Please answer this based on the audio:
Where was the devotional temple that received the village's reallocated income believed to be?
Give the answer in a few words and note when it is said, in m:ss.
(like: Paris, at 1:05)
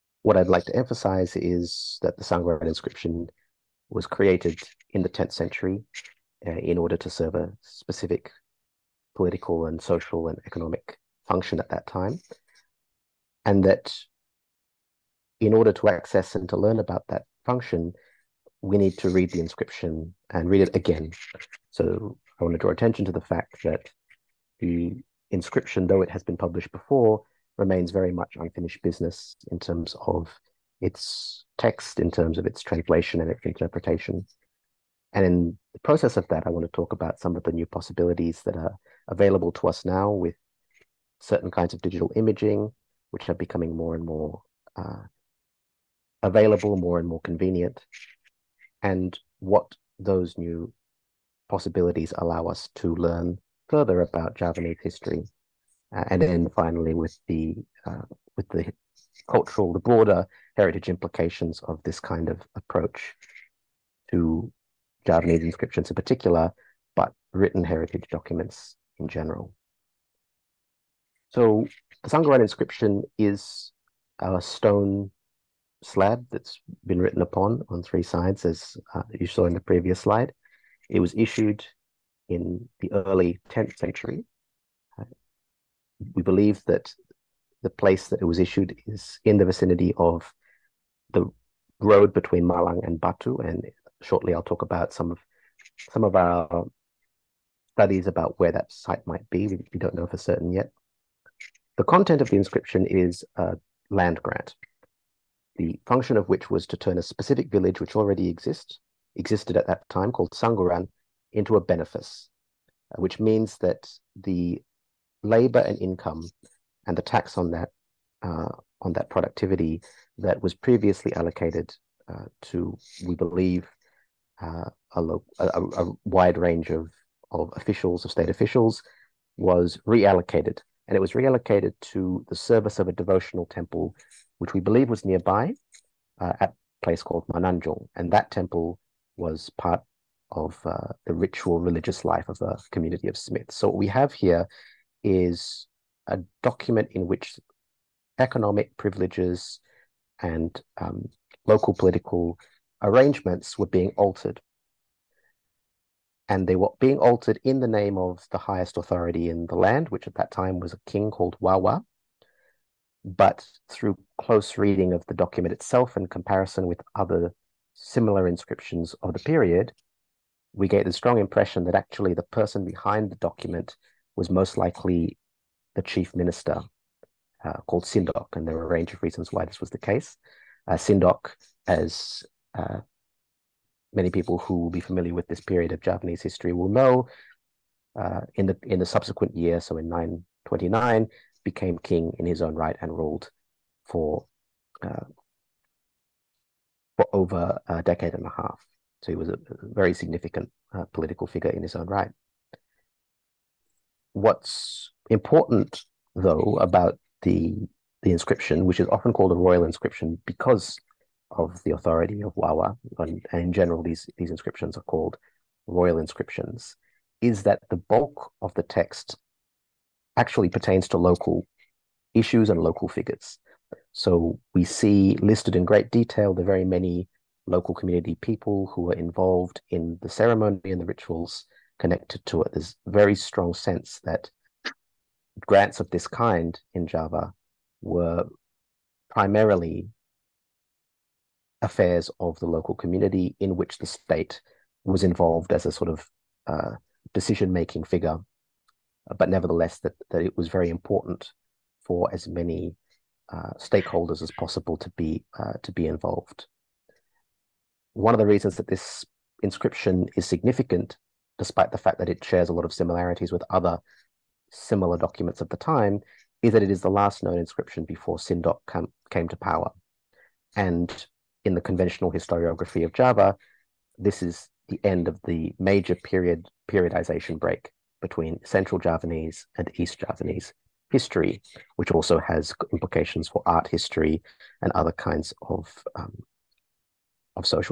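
Mananjung, at 2:17.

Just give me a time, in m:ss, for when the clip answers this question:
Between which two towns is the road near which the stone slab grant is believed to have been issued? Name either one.
1:32.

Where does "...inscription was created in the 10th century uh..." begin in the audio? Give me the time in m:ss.
0:02.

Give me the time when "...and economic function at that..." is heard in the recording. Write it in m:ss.
0:10.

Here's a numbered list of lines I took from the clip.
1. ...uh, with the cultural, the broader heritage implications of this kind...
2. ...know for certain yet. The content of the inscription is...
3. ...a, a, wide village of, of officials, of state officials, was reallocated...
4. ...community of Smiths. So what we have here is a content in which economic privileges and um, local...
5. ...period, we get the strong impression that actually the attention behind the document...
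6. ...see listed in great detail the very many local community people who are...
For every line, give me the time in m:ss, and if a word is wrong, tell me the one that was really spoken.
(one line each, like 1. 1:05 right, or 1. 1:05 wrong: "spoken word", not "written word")
1. 0:57 right
2. 1:39 right
3. 2:05 wrong: "range", not "village"
4. 2:22 wrong: "document", not "content"
5. 2:49 wrong: "person", not "attention"
6. 3:44 right.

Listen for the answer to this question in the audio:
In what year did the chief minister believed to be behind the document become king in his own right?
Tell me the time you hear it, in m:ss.
3:09.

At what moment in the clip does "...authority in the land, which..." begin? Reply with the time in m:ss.
2:38.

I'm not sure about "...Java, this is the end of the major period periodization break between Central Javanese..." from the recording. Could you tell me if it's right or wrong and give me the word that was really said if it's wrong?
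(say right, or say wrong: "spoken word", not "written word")
right.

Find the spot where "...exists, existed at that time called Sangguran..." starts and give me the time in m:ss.
1:48.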